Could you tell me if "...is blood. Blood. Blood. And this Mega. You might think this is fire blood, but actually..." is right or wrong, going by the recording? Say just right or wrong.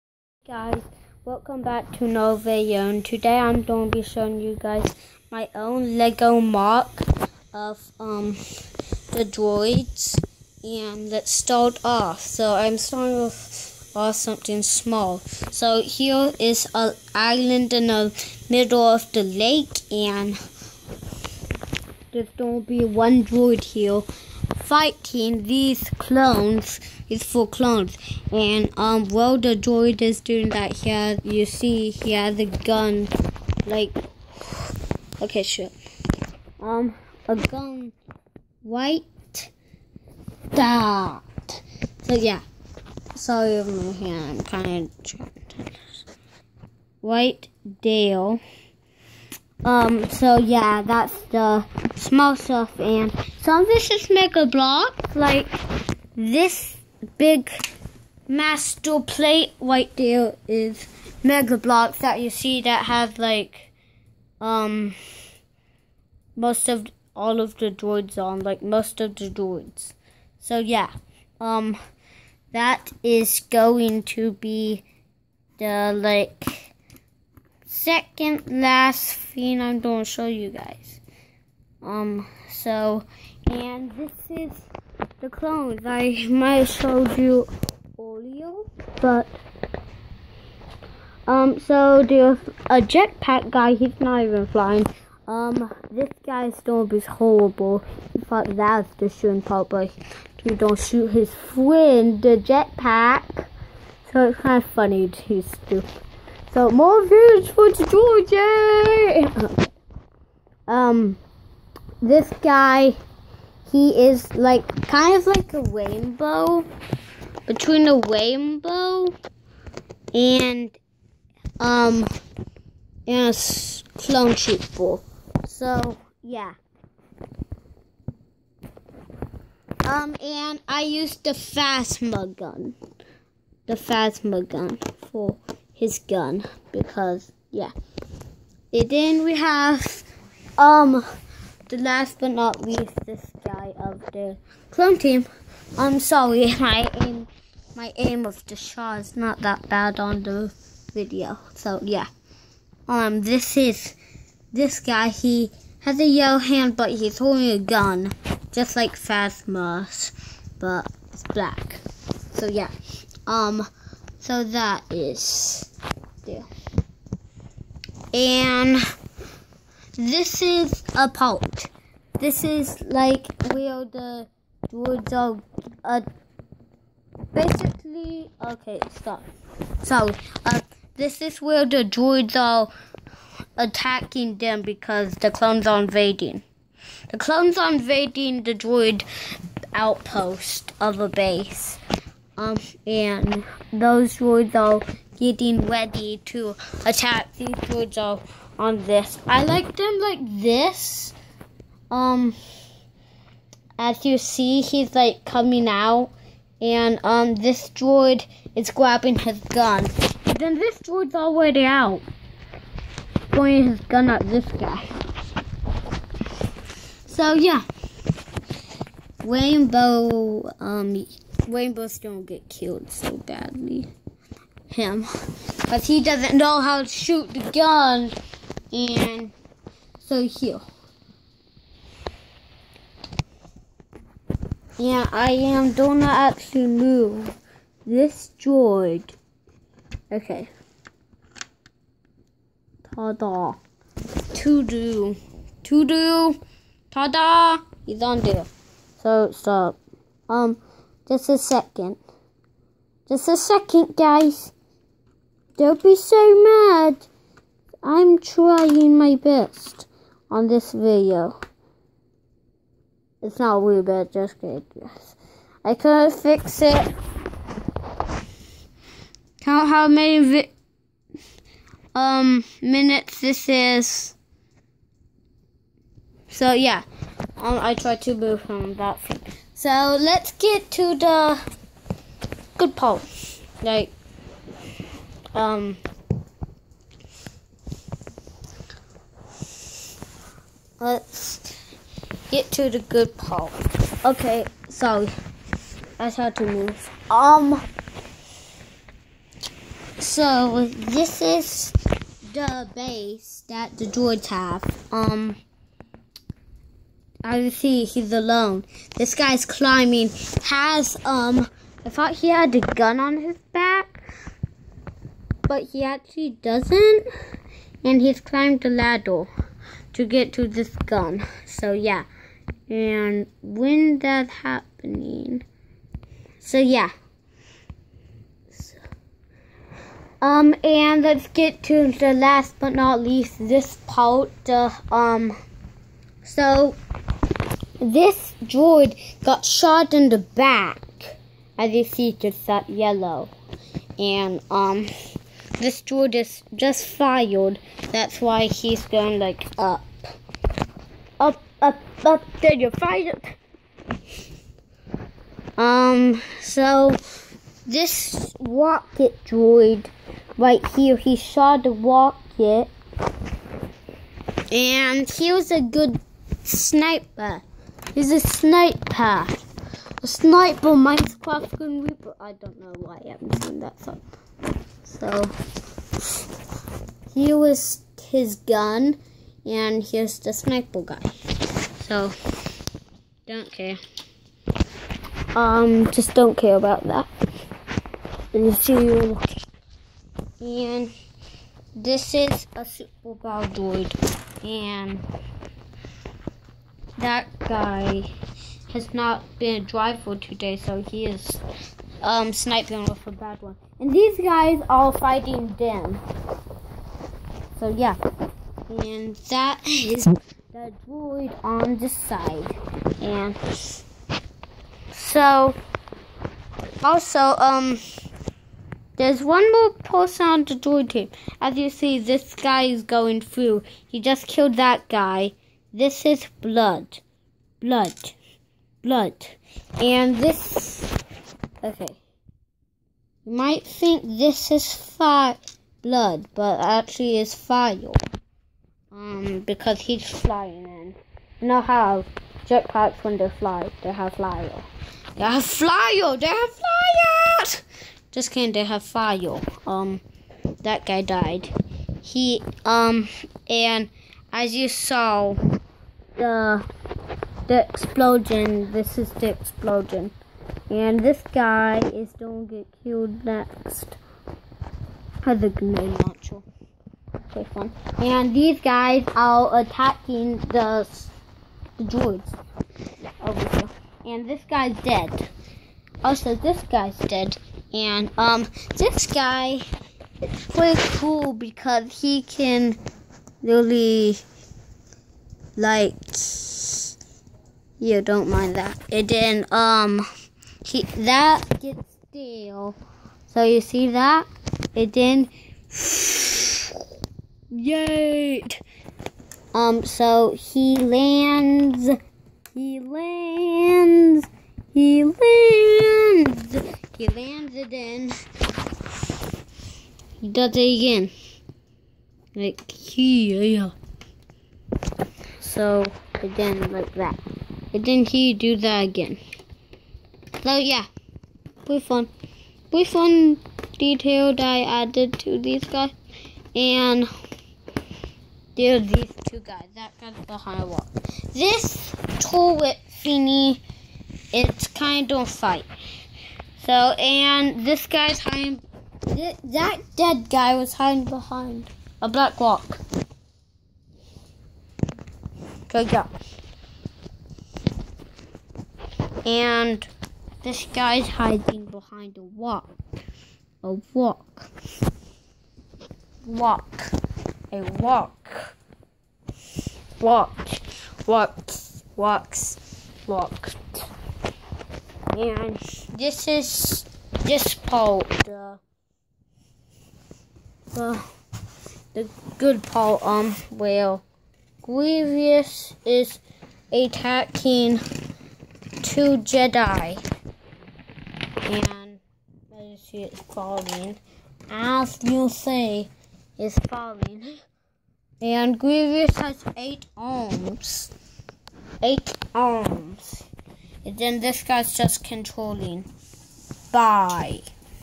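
wrong.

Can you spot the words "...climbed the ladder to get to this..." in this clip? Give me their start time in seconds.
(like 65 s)
318 s.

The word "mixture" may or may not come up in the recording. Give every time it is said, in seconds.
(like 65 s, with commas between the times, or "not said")
not said.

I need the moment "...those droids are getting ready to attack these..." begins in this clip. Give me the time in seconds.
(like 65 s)
193 s.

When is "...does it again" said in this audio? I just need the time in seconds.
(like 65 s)
510 s.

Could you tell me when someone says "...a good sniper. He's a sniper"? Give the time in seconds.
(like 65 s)
365 s.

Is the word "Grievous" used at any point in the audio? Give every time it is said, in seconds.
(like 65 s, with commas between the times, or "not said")
574 s, 588 s.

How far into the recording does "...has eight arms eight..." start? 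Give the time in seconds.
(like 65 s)
589 s.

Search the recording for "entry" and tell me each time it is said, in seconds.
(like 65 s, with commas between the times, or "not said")
not said.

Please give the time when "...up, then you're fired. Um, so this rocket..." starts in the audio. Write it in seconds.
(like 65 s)
352 s.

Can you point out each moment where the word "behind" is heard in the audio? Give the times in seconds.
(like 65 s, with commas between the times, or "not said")
530 s, 541 s, 551 s.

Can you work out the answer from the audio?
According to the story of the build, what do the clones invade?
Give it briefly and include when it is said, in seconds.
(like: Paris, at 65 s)
droid outpost, at 188 s.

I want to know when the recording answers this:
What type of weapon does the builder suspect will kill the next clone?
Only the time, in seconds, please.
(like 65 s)
465 s.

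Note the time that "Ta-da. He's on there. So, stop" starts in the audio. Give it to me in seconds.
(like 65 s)
246 s.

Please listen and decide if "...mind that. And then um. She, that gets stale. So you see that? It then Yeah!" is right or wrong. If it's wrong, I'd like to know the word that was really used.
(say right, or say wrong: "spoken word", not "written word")
wrong: "Yay", not "Yeah".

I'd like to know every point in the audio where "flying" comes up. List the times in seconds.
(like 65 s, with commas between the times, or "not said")
94 s, 440 s.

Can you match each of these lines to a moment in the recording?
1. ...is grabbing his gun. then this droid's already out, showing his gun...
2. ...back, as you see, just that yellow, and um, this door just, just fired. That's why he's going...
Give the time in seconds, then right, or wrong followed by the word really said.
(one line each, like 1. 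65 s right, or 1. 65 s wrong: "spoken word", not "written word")
1. 208 s wrong: "pointing", not "showing"
2. 340 s right.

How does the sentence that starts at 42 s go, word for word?
So yeah, sorry, my hand, kind of White Dale.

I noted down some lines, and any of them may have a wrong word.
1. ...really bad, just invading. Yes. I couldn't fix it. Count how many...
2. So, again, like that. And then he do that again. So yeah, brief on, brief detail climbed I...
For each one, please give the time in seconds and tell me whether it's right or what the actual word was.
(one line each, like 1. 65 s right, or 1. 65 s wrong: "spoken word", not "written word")
1. 263 s wrong: "kidding", not "invading"
2. 515 s wrong: "detailed", not "climbed".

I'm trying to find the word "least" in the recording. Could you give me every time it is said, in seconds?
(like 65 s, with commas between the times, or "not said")
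142 s, 333 s.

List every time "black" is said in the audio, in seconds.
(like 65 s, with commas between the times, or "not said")
161 s, 542 s.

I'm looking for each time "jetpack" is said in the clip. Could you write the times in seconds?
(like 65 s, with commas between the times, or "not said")
92 s, 102 s, 442 s.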